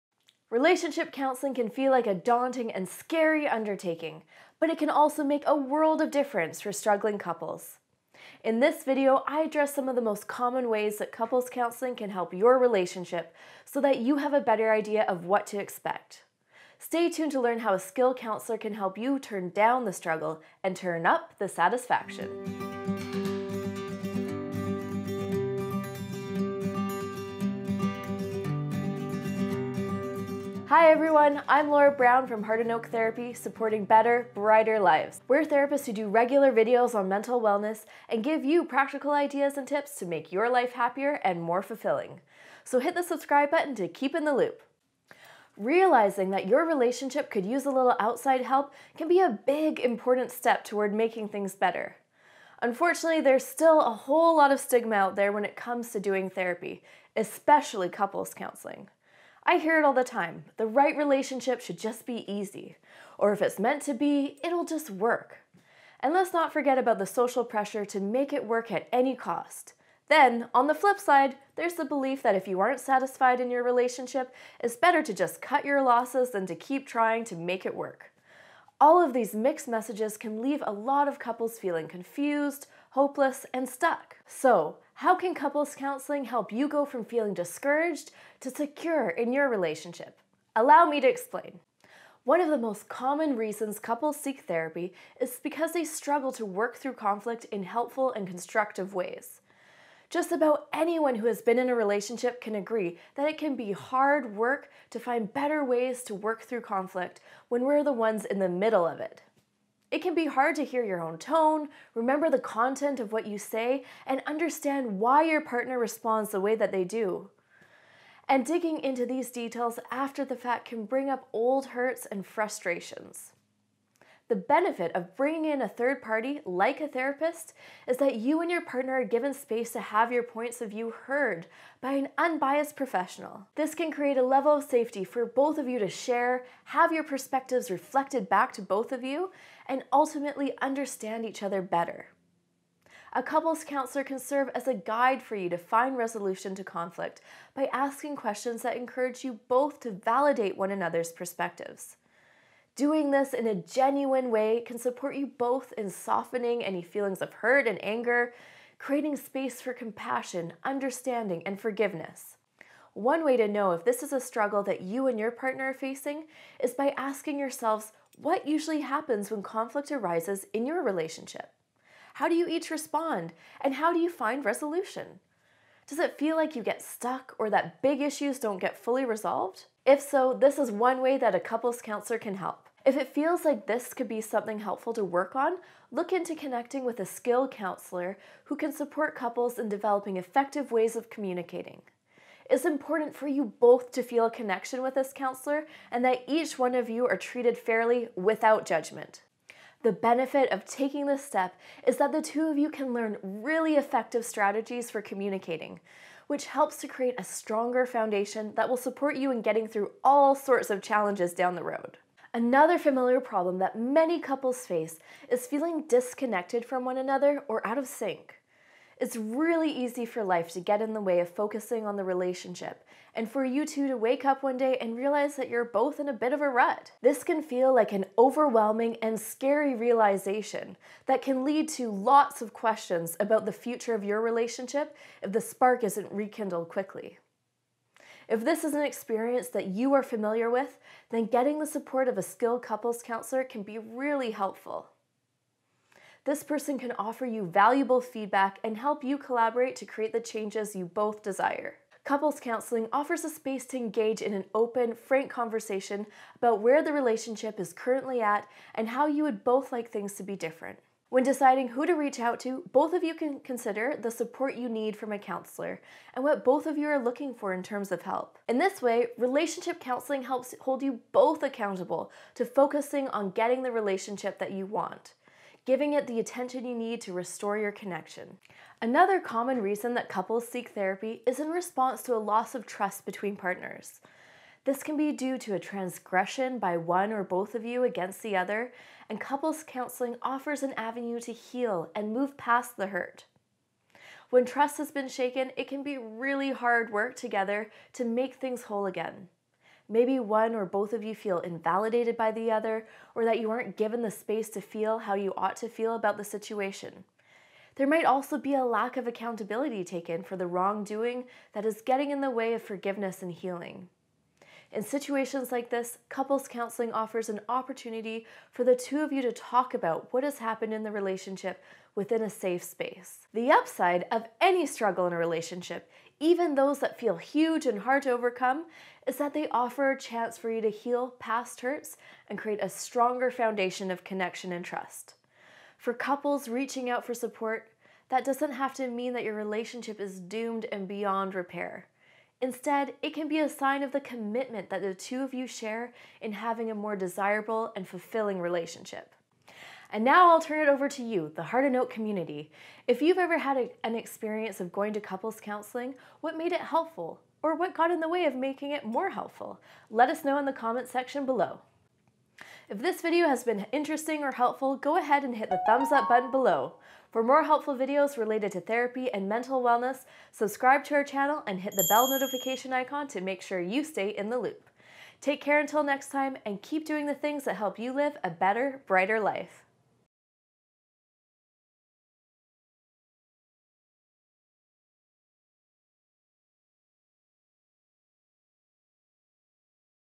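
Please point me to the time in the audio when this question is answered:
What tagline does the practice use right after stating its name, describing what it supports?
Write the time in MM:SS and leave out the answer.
00:33.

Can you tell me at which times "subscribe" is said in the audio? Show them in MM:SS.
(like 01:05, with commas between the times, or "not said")
00:43, 06:10.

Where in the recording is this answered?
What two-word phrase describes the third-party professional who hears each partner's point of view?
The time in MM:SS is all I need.
02:12.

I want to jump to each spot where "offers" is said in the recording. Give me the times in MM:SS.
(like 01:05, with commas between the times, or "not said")
04:06, 04:12, 04:50, 05:16, 05:29.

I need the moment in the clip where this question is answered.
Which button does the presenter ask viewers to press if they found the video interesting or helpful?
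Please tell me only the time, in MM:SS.
06:05.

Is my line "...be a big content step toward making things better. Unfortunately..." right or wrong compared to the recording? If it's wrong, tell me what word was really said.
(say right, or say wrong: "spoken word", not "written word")
wrong: "important", not "content".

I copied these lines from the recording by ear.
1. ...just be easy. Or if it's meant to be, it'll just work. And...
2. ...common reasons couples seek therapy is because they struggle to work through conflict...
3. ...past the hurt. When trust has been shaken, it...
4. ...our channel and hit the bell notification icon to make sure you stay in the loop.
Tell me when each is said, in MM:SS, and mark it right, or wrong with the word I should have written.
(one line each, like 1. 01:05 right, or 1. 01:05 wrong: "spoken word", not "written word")
1. 01:01 right
2. 01:32 right
3. 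04:52 right
4. 06:10 right.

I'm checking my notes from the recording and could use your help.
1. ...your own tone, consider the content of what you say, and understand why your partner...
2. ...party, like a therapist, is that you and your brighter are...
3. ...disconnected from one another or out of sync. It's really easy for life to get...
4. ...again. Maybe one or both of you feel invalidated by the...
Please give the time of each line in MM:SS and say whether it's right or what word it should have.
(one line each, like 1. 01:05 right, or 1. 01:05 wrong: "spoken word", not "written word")
1. 01:50 wrong: "remember", not "consider"
2. 02:06 wrong: "partner", not "brighter"
3. 03:35 right
4. 04:58 right.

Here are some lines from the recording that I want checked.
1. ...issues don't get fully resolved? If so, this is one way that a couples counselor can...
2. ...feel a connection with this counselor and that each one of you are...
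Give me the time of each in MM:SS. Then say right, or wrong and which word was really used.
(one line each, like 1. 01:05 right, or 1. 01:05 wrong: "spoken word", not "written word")
1. 02:58 right
2. 03:14 right.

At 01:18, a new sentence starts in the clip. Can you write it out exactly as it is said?
All of these mixed messages can leave a lot of couples feeling confused, hopeless, and stuck.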